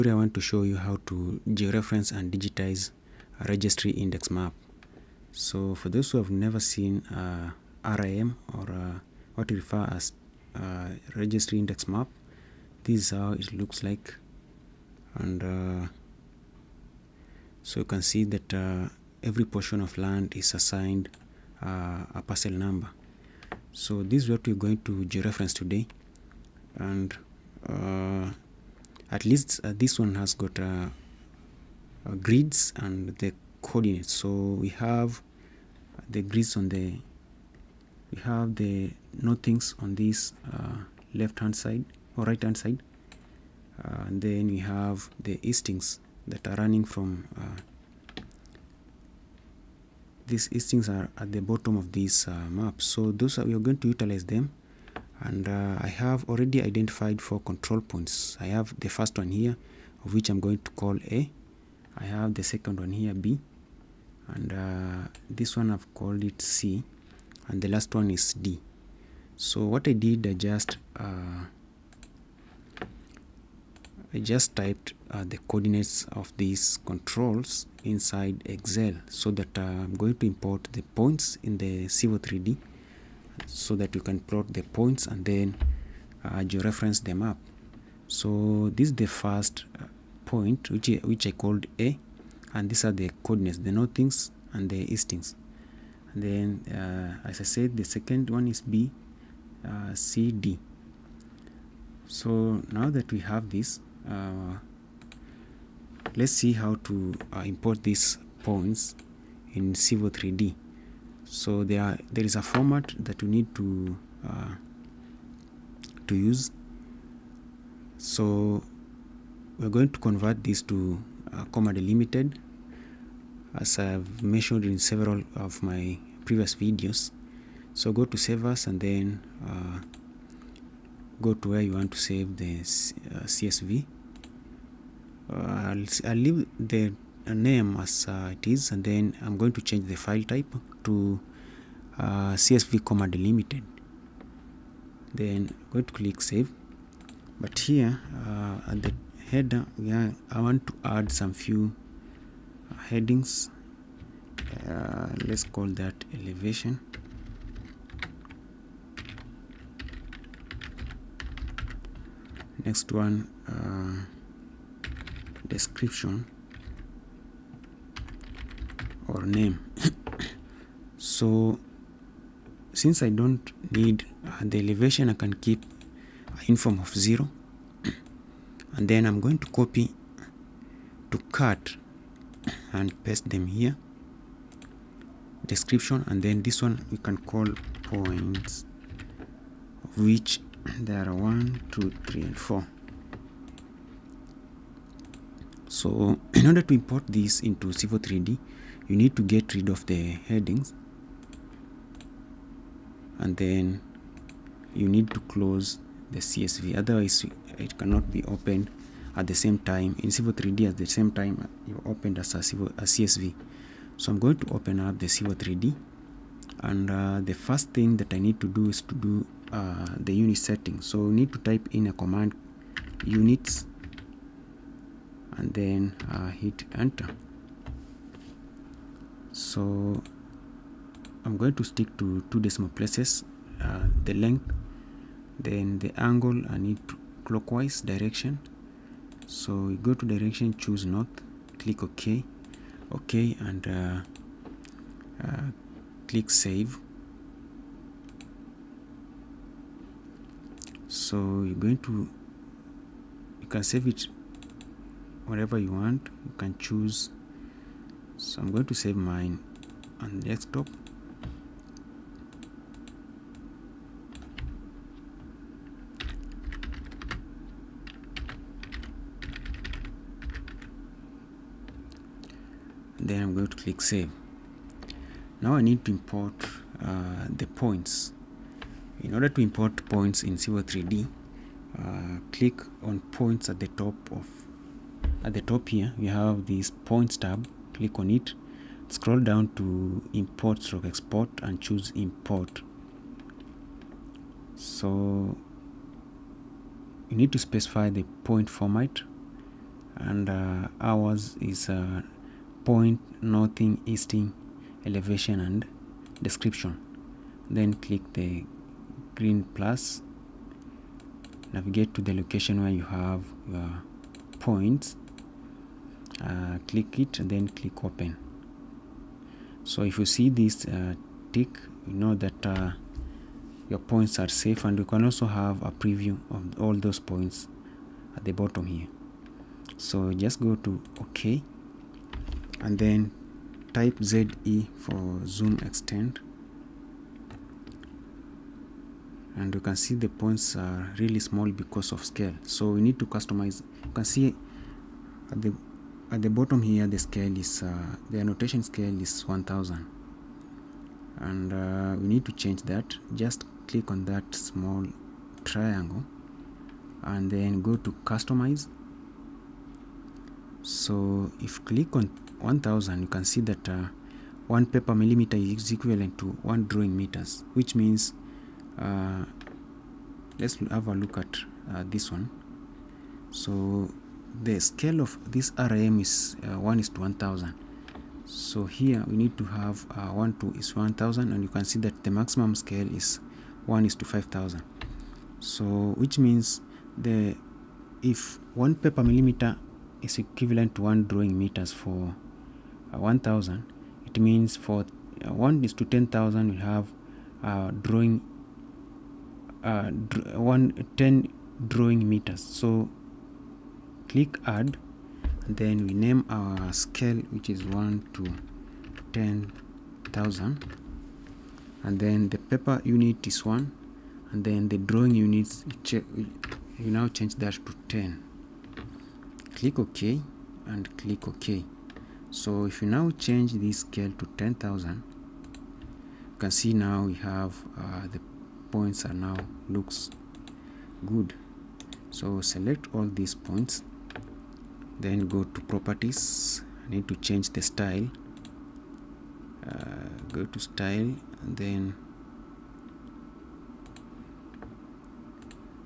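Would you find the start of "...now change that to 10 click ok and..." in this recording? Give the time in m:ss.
6:56.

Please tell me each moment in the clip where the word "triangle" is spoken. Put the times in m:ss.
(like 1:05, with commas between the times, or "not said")
5:55.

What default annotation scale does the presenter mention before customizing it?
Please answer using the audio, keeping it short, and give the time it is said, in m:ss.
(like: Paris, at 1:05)
1000, at 5:48.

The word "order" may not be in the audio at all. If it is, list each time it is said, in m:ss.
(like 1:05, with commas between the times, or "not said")
3:16, 4:39.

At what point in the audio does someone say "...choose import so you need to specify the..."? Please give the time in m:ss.
4:51.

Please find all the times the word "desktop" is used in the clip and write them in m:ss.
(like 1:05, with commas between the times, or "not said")
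4:20.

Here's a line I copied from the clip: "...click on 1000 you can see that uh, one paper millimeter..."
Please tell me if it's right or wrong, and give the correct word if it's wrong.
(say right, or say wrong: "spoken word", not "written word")
right.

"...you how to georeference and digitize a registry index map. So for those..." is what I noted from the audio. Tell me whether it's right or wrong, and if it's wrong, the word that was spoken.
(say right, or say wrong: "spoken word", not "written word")
right.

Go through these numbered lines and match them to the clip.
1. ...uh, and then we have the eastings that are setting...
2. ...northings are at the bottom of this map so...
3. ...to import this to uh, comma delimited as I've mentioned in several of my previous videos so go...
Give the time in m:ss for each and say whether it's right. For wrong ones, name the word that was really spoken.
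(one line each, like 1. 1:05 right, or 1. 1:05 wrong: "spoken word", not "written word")
1. 0:43 wrong: "running", not "setting"
2. 0:50 wrong: "eastings", not "northings"
3. 1:59 wrong: "convert", not "import".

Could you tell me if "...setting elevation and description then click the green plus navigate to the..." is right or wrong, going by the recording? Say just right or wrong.
wrong.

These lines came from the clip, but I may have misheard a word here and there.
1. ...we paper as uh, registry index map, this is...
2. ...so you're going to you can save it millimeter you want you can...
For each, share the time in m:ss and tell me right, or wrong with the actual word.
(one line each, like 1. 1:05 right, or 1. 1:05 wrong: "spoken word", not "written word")
1. 0:09 wrong: "refer", not "paper"
2. 4:10 wrong: "whatever", not "millimeter".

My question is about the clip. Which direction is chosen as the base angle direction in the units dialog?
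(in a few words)
North.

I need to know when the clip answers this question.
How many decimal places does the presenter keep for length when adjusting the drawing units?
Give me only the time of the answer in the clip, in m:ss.
3:52.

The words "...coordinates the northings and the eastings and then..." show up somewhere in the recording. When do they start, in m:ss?
1:33.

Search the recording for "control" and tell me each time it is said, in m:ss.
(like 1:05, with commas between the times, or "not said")
0:57, 1:16.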